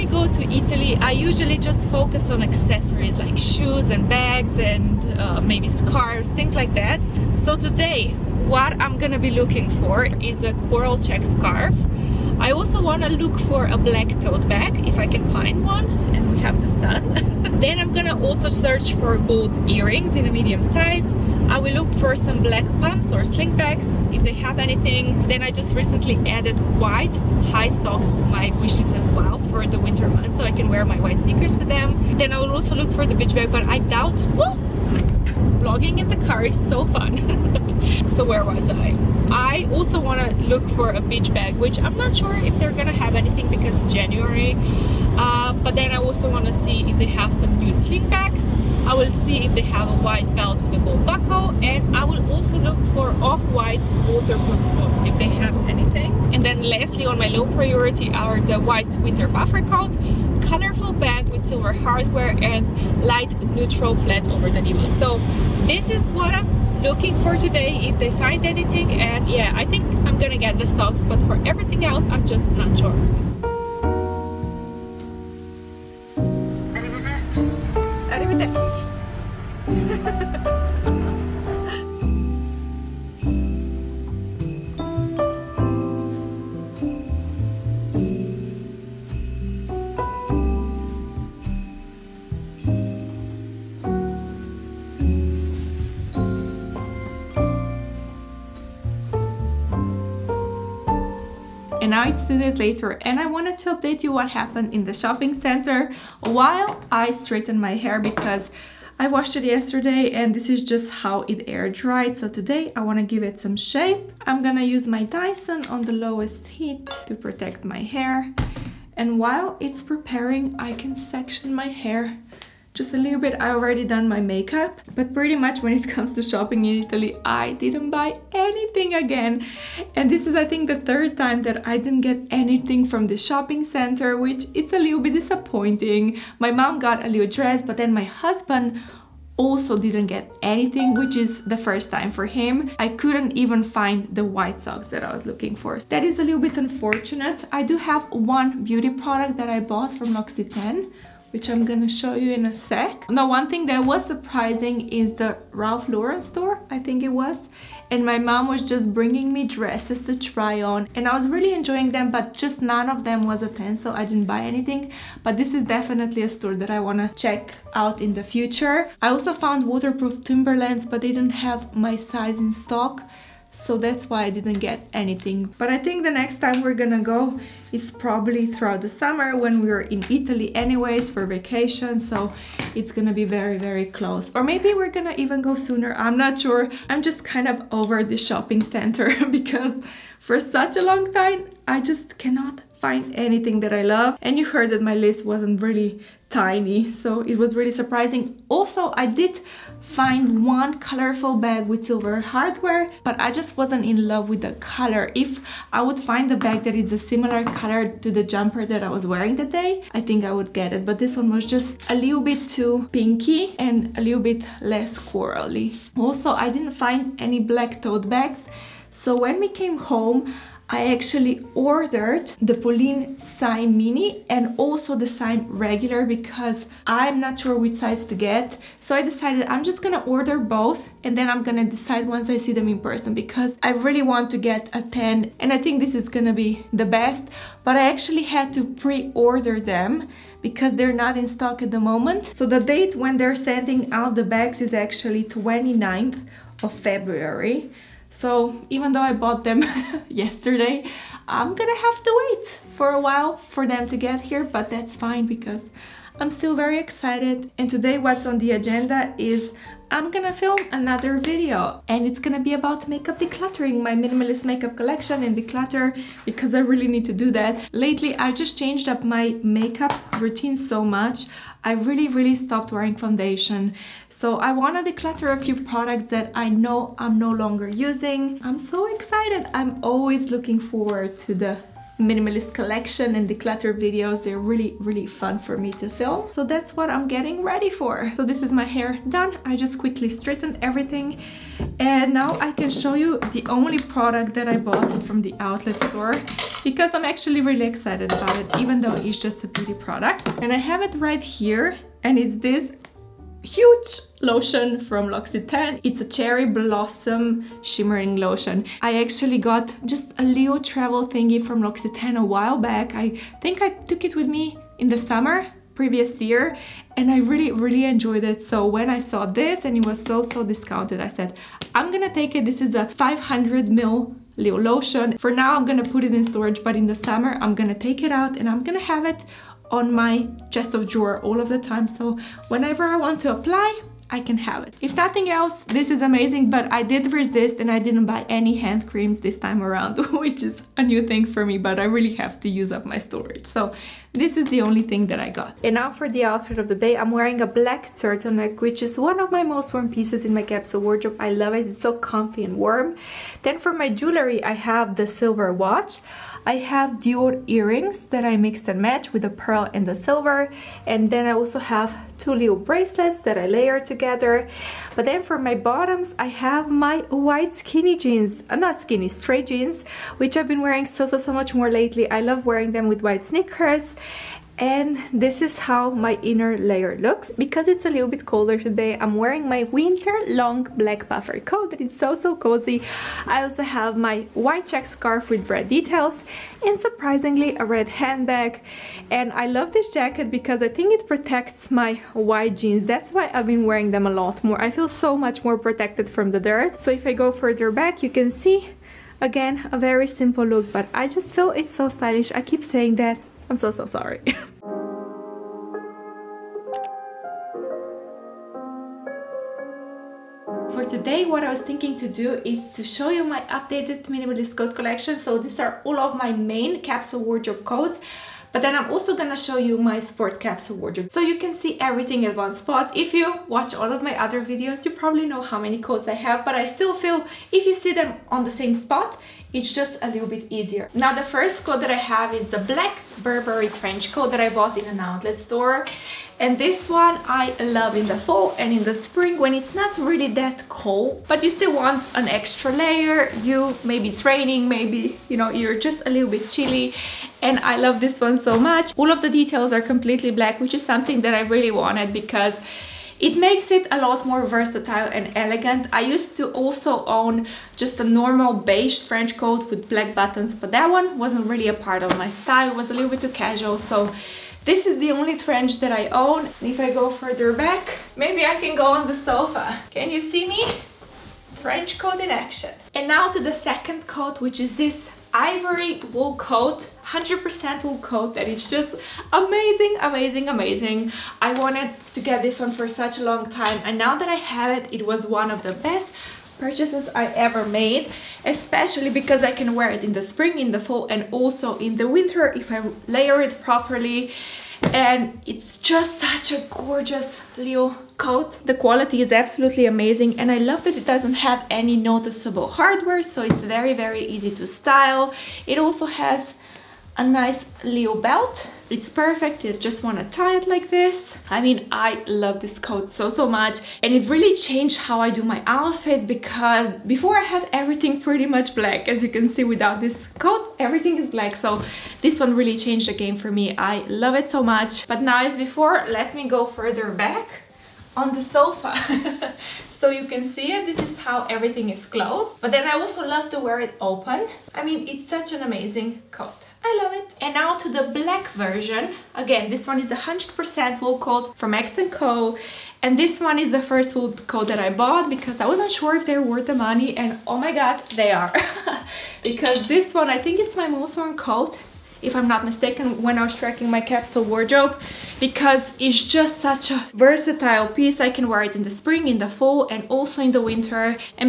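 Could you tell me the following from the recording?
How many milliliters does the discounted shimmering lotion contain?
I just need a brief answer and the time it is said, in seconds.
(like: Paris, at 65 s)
500, at 322 s.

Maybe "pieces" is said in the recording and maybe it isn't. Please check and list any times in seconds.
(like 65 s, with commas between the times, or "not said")
349 s, 557 s.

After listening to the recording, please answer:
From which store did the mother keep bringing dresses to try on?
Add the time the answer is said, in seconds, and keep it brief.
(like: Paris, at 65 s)
Ralph Lauren, at 155 s.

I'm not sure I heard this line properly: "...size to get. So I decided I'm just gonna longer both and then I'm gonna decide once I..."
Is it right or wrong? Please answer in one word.
wrong.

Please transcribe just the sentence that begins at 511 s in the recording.
I mean, I love this coat so, so much.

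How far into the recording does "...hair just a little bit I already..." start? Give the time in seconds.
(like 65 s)
121 s.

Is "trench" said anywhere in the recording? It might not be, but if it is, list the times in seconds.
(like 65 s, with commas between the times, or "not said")
433 s, 459 s, 465 s, 471 s.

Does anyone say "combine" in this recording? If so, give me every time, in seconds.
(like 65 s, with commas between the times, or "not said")
not said.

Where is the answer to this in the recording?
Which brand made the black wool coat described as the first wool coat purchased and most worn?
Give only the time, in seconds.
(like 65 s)
541 s.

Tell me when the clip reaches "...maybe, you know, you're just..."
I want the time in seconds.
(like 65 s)
444 s.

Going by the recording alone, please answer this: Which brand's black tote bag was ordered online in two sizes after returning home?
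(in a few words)
Polène.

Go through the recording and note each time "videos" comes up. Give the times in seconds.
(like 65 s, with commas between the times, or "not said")
261 s, 283 s, 424 s.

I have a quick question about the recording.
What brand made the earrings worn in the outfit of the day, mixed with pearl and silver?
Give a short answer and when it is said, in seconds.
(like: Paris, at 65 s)
Dior, at 356 s.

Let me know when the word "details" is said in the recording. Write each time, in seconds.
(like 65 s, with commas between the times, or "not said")
385 s, 449 s.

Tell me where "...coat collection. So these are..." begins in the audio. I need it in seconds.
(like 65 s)
414 s.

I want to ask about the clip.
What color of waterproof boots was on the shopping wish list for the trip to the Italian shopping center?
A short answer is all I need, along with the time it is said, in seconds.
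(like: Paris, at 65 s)
Off-white, at 53 s.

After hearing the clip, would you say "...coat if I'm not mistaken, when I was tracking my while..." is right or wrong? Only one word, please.
wrong.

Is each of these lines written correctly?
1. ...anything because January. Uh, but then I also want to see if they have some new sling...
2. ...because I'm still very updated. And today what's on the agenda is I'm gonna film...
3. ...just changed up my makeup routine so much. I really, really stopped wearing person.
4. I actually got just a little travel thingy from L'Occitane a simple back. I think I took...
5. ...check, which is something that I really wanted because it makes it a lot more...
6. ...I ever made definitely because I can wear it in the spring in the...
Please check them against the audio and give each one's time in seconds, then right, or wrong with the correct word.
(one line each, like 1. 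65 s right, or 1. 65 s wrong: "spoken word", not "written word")
1. 43 s right
2. 255 s wrong: "excited", not "updated"
3. 268 s wrong: "foundation", not "person"
4. 308 s wrong: "while", not "simple"
5. 450 s wrong: "black", not "check"
6. 487 s wrong: "especially", not "definitely".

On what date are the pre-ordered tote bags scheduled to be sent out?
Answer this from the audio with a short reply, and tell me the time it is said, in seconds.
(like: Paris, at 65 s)
29 February, at 245 s.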